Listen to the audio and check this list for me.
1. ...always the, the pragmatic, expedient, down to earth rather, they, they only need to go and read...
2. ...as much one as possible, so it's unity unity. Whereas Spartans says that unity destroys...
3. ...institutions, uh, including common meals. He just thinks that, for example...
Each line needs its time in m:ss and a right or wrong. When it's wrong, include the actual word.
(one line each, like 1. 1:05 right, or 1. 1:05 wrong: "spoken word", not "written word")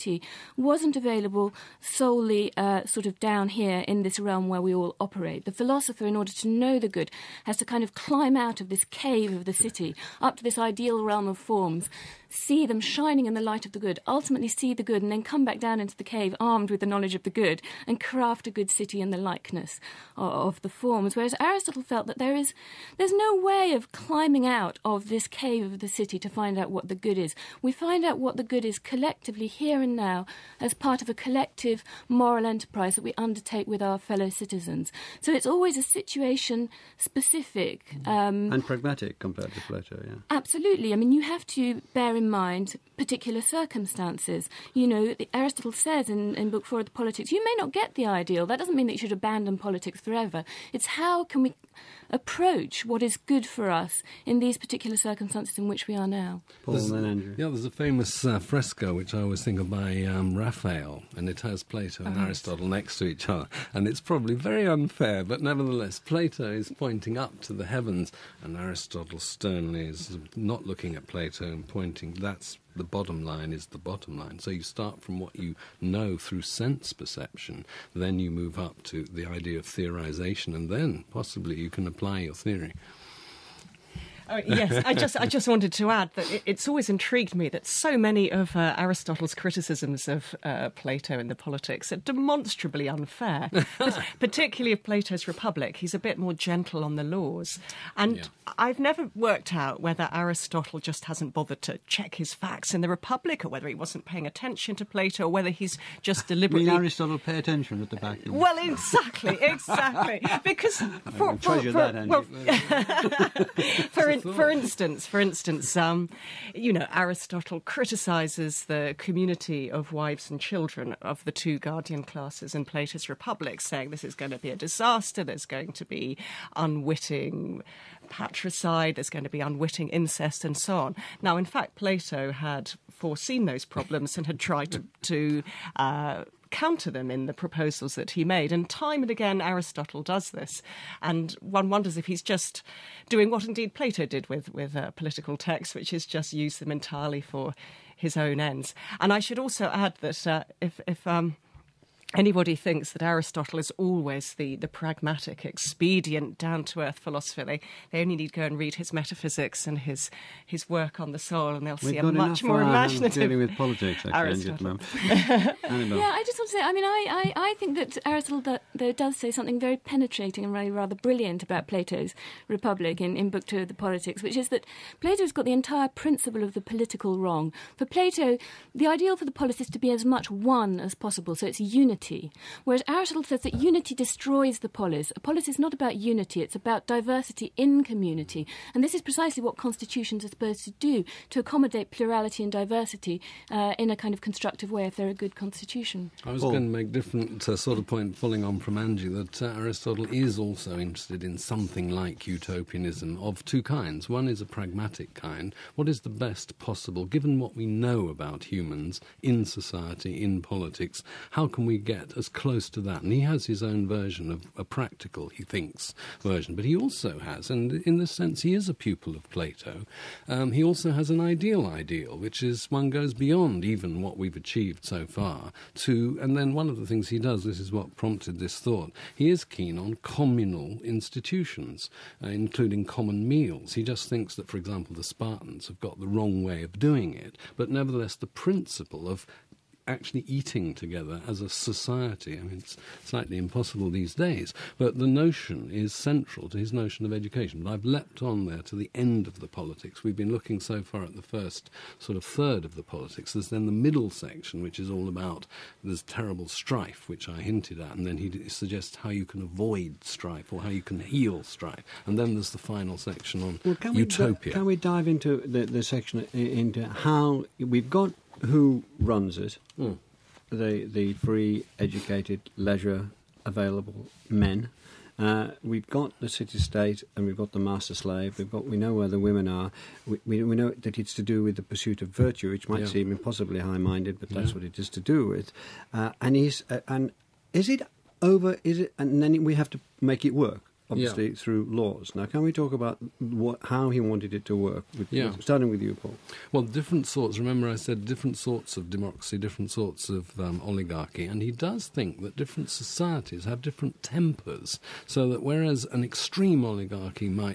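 1. 2:33 wrong: "philosopher", not "rather"
2. 2:59 wrong: "Aristotle", not "Spartans"
3. 3:50 right.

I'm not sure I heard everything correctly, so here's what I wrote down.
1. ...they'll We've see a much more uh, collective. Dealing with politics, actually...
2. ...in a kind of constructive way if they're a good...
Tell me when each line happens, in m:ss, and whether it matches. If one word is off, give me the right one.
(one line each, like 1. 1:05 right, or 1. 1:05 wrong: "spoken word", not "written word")
1. 2:41 wrong: "imaginative", not "collective"
2. 3:13 right.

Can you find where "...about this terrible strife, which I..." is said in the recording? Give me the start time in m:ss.
4:15.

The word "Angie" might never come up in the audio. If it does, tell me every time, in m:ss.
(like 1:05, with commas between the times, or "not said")
3:18.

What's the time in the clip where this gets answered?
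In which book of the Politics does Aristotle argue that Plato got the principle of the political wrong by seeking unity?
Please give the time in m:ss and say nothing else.
2:53.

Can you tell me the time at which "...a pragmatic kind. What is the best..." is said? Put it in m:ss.
3:24.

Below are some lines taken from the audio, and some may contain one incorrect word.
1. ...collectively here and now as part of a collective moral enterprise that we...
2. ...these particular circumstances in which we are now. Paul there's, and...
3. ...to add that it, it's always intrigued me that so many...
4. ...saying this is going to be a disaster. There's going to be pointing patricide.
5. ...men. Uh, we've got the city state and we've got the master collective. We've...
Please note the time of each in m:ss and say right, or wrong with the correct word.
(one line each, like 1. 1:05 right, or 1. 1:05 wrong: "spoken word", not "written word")
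1. 0:28 right
2. 0:54 right
3. 1:25 right
4. 2:03 wrong: "unwitting", not "pointing"
5. 4:34 wrong: "slave", not "collective".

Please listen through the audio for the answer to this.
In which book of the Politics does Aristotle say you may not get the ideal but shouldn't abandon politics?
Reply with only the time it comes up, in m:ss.
0:46.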